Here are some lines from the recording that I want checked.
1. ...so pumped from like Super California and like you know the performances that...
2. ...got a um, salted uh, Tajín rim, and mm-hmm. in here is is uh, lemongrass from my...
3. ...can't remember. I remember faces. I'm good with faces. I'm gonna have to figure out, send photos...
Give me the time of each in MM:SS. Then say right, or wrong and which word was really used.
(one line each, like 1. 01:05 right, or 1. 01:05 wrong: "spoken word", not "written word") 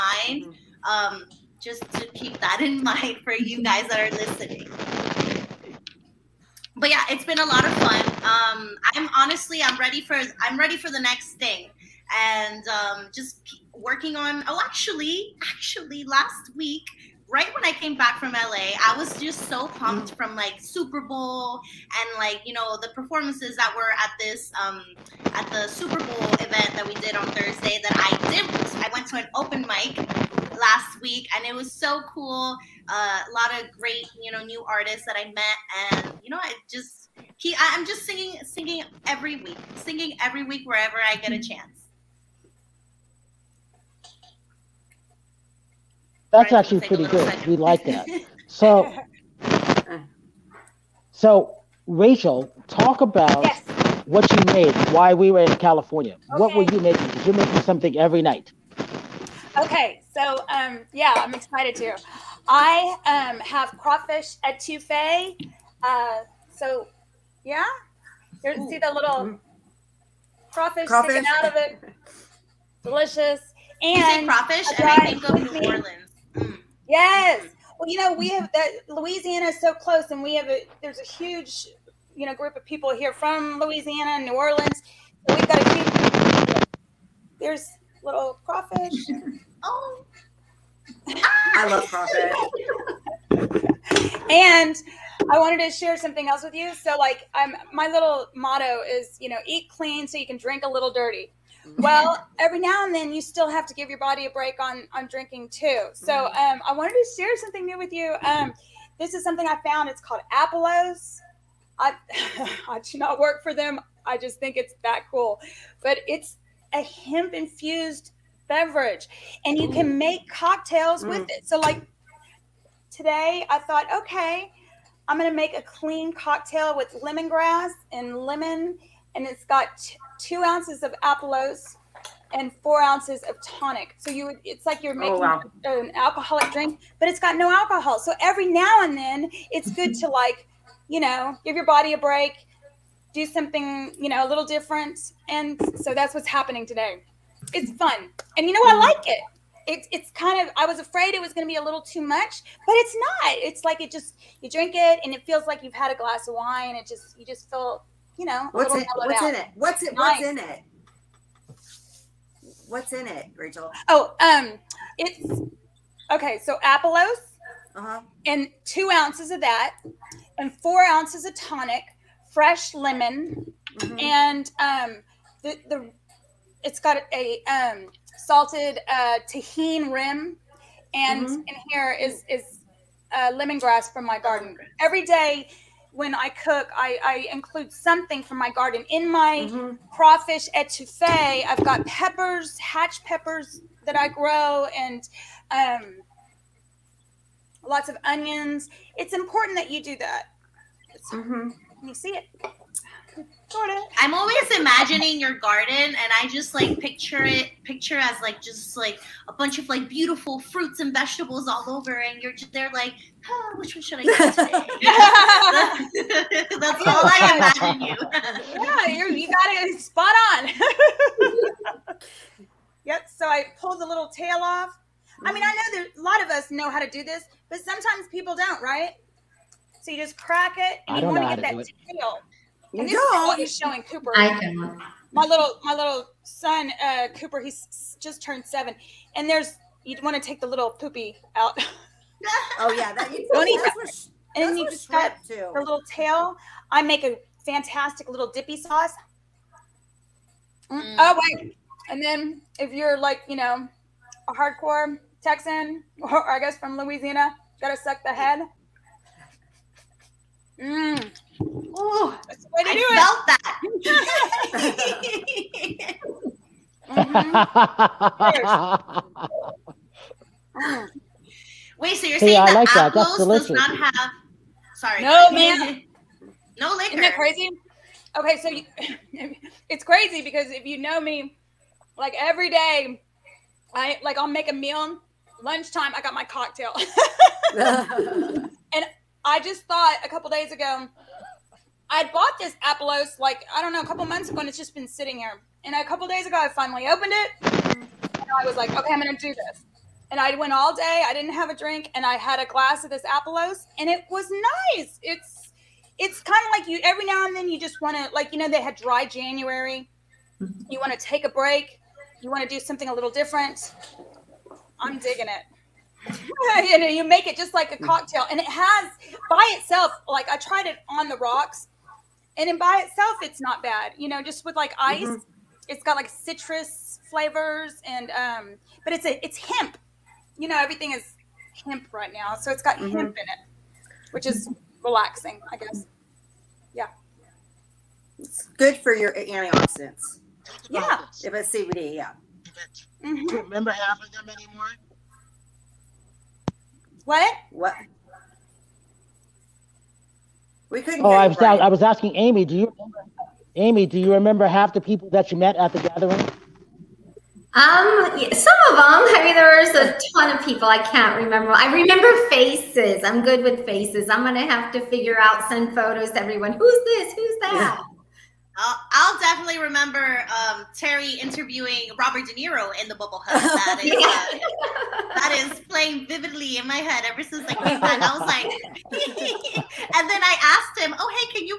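1. 00:19 wrong: "Bowl", not "California"
2. 02:56 right
3. 06:00 right.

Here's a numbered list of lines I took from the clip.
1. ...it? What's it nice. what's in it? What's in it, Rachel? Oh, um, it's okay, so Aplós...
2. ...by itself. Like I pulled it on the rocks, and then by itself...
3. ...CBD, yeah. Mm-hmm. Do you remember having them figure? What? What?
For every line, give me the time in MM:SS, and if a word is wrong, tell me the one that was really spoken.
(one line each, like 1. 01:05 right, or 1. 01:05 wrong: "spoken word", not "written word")
1. 02:39 right
2. 05:19 wrong: "tried", not "pulled"
3. 05:41 wrong: "anymore", not "figure".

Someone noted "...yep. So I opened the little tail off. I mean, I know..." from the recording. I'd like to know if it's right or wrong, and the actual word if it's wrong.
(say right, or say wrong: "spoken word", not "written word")
wrong: "pulled", not "opened".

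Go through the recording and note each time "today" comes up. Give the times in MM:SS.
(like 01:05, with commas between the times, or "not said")
02:02, 02:26, 03:34.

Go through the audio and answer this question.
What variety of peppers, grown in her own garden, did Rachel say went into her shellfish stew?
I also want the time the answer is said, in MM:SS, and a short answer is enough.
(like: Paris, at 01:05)
Hatch peppers, at 03:12.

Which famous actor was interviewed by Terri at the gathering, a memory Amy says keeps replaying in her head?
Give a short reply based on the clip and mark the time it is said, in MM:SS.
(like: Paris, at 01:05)
Robert De Niro, at 06:11.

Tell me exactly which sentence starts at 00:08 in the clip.
Um, I'm honestly, I'm ready for, I'm ready for the next thing, and um, just working on.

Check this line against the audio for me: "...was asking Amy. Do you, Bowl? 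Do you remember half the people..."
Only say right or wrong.
wrong.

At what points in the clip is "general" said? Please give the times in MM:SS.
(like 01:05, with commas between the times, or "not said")
not said.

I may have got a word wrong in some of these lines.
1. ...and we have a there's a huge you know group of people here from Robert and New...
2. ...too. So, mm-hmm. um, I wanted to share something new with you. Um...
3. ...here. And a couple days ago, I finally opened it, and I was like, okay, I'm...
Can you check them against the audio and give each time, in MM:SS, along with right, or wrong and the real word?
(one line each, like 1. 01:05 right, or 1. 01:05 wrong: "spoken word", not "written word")
1. 01:20 wrong: "Louisiana", not "Robert"
2. 01:45 right
3. 04:55 right.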